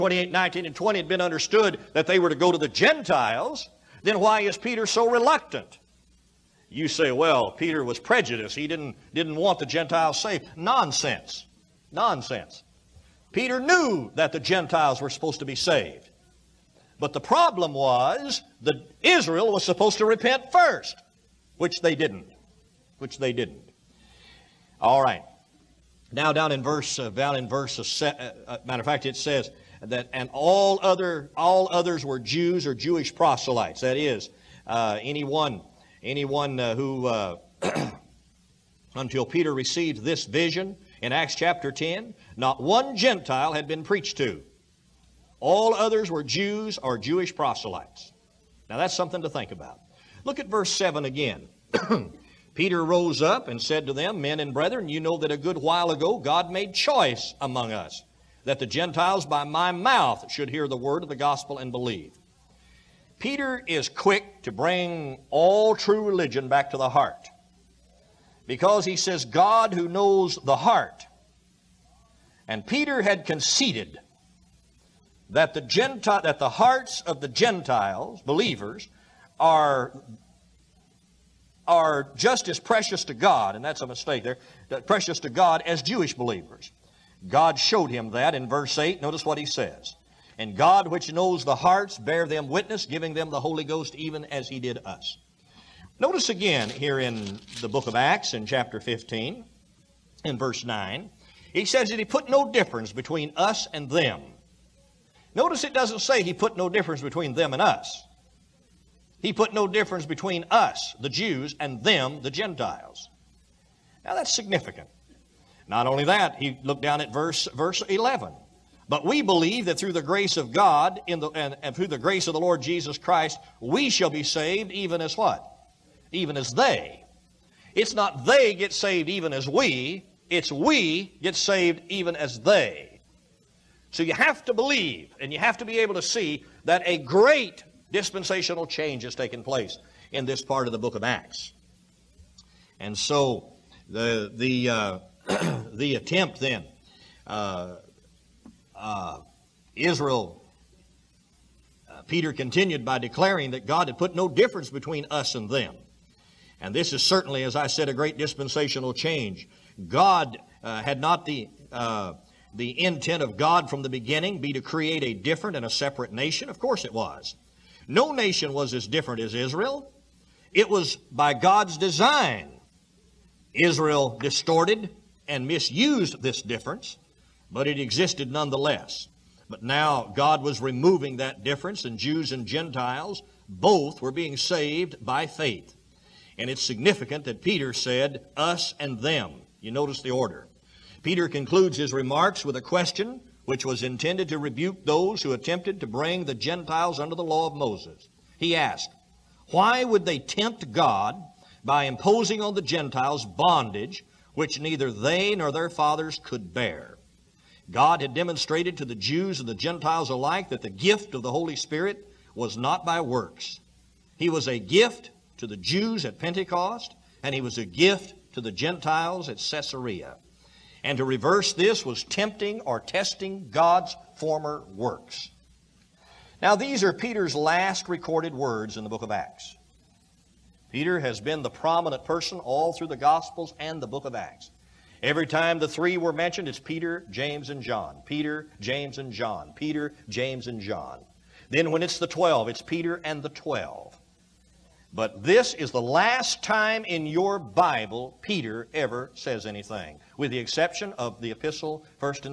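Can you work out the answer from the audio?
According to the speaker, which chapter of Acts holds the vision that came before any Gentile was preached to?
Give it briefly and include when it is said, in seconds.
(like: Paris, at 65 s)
Chapter 10, at 41 s.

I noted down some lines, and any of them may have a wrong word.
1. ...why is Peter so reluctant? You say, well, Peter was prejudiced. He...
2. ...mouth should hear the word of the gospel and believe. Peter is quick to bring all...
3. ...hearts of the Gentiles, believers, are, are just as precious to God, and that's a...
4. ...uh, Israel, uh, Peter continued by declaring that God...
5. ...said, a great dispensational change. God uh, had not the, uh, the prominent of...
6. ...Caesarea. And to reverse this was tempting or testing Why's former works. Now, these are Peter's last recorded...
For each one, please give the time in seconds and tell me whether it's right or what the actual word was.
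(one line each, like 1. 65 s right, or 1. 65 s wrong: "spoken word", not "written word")
1. 4 s right
2. 59 s right
3. 76 s right
4. 148 s right
5. 157 s wrong: "intent", not "prominent"
6. 219 s wrong: "God", not "Why".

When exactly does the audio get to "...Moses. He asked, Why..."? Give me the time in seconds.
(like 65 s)
197 s.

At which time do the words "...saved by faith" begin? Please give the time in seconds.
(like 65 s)
184 s.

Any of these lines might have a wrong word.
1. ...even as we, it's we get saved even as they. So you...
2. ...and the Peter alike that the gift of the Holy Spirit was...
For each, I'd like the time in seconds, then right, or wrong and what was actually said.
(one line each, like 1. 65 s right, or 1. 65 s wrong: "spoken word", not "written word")
1. 129 s right
2. 209 s wrong: "Gentiles", not "Peter".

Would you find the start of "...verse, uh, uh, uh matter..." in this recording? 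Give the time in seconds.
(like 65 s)
27 s.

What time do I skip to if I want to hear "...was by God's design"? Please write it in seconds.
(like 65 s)
170 s.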